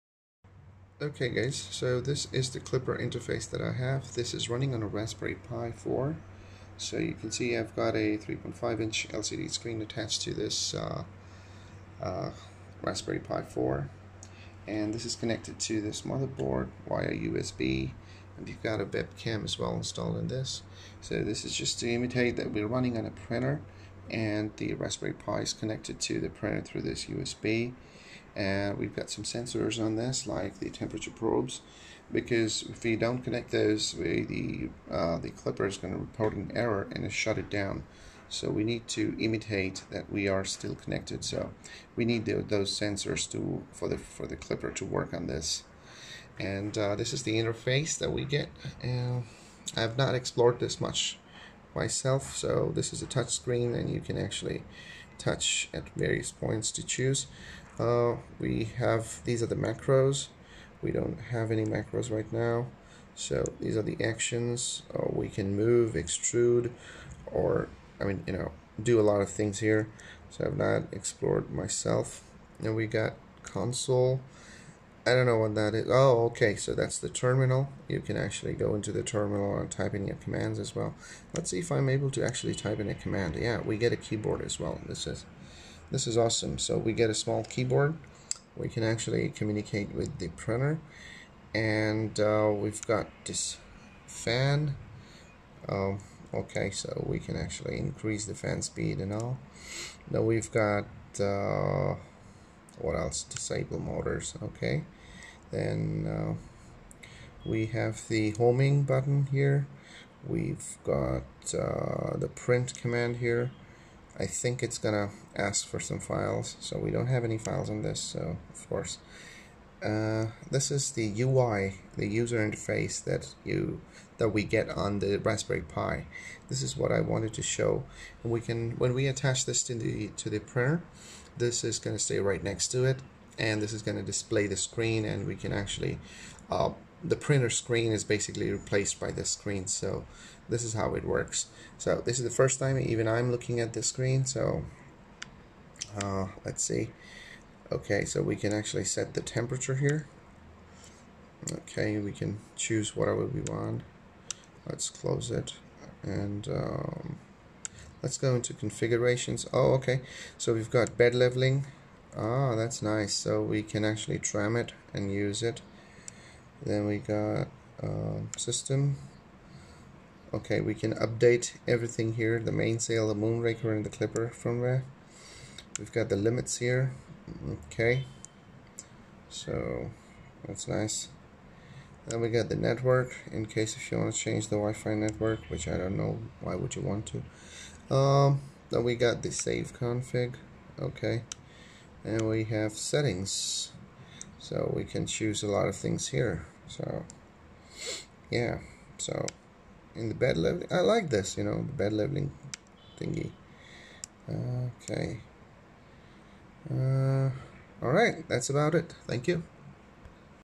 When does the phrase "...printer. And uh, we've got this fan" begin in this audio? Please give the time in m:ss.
1:30.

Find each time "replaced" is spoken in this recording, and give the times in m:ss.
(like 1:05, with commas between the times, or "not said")
2:18.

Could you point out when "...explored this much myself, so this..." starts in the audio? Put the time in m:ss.
0:50.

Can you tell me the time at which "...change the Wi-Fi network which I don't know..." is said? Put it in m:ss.
3:04.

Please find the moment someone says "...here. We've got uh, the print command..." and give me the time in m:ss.
1:49.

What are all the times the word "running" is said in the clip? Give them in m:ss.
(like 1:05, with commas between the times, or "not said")
0:04, 0:22.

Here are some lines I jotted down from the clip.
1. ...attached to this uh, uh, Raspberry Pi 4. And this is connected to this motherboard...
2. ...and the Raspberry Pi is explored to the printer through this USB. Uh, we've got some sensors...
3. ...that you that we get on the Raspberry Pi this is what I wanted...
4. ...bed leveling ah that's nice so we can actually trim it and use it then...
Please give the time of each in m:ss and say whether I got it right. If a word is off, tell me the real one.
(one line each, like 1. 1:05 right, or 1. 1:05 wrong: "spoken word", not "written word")
1. 0:09 right
2. 0:24 wrong: "connected", not "explored"
3. 2:03 right
4. 2:40 right.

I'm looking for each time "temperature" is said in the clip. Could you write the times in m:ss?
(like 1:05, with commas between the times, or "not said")
0:30, 2:29.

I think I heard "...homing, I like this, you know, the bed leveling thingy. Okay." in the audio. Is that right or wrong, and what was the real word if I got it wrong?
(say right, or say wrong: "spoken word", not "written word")
wrong: "leveling", not "homing".